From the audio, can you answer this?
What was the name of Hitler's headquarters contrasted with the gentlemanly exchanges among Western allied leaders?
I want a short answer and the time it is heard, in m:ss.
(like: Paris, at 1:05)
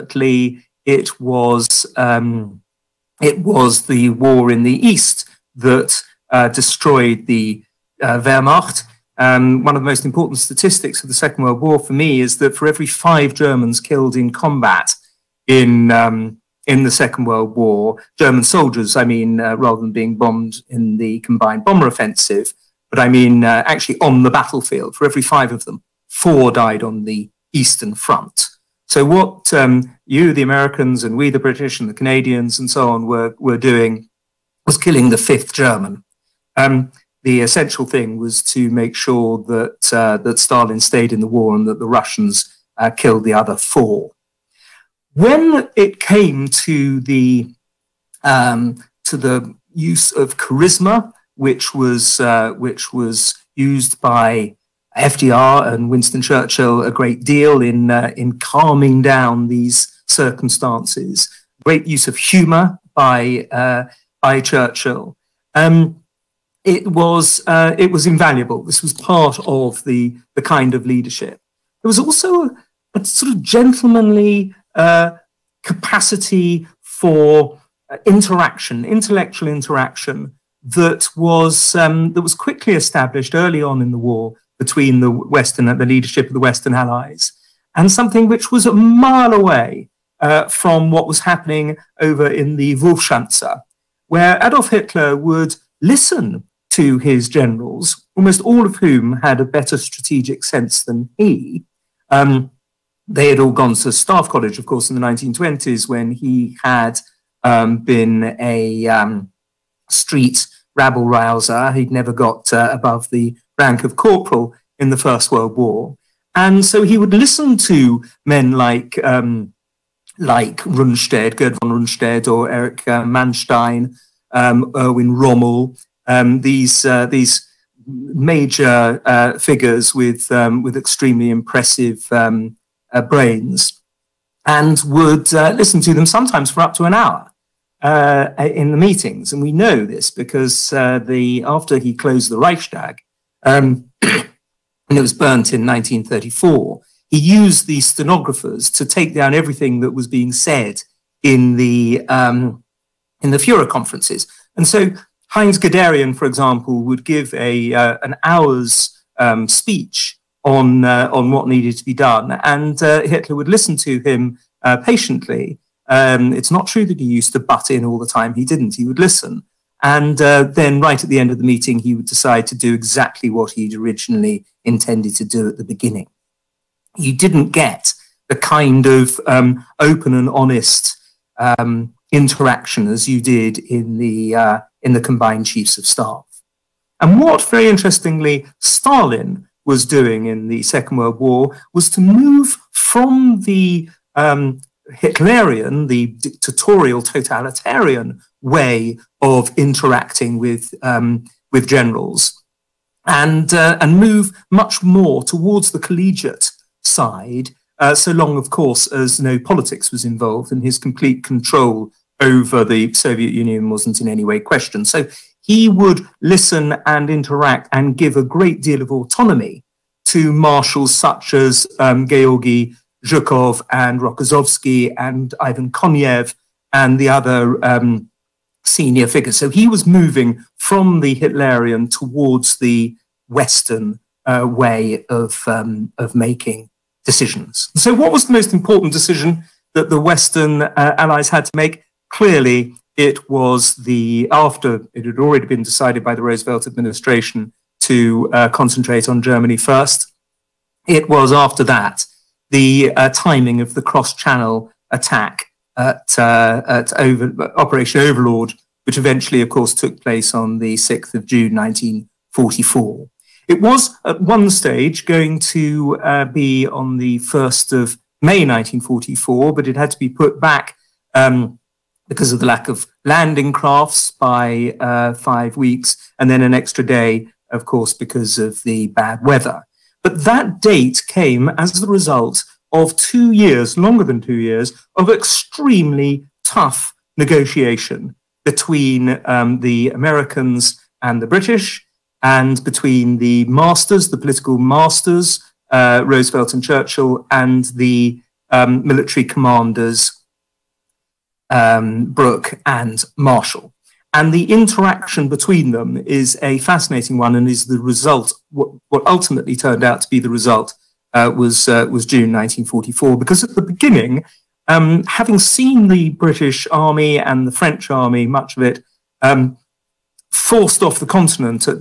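Wolfschanze, at 1:32.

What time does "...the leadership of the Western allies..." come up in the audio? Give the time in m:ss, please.
1:25.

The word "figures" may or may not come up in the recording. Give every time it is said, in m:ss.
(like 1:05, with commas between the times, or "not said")
2:09, 3:49.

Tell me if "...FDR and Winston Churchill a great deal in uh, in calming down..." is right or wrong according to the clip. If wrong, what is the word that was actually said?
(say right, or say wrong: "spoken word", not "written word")
right.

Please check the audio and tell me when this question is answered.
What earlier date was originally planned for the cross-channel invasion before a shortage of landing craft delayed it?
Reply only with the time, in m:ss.
4:27.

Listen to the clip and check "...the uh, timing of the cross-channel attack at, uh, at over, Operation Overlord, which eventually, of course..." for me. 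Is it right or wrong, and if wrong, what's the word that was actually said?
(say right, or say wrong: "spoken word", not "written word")
right.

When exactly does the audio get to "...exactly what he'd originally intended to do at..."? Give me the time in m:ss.
2:52.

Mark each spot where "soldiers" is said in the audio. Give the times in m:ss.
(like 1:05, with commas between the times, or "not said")
0:18.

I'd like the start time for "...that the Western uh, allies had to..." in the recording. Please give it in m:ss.
3:59.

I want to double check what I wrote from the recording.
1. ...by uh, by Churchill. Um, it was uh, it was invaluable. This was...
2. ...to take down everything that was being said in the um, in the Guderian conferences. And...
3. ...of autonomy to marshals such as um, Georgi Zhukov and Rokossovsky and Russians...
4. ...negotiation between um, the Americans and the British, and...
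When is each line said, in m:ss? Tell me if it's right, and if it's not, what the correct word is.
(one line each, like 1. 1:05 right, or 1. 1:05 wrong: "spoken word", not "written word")
1. 1:02 right
2. 2:28 wrong: "Führer", not "Guderian"
3. 3:38 wrong: "Ivan", not "Russians"
4. 4:47 right.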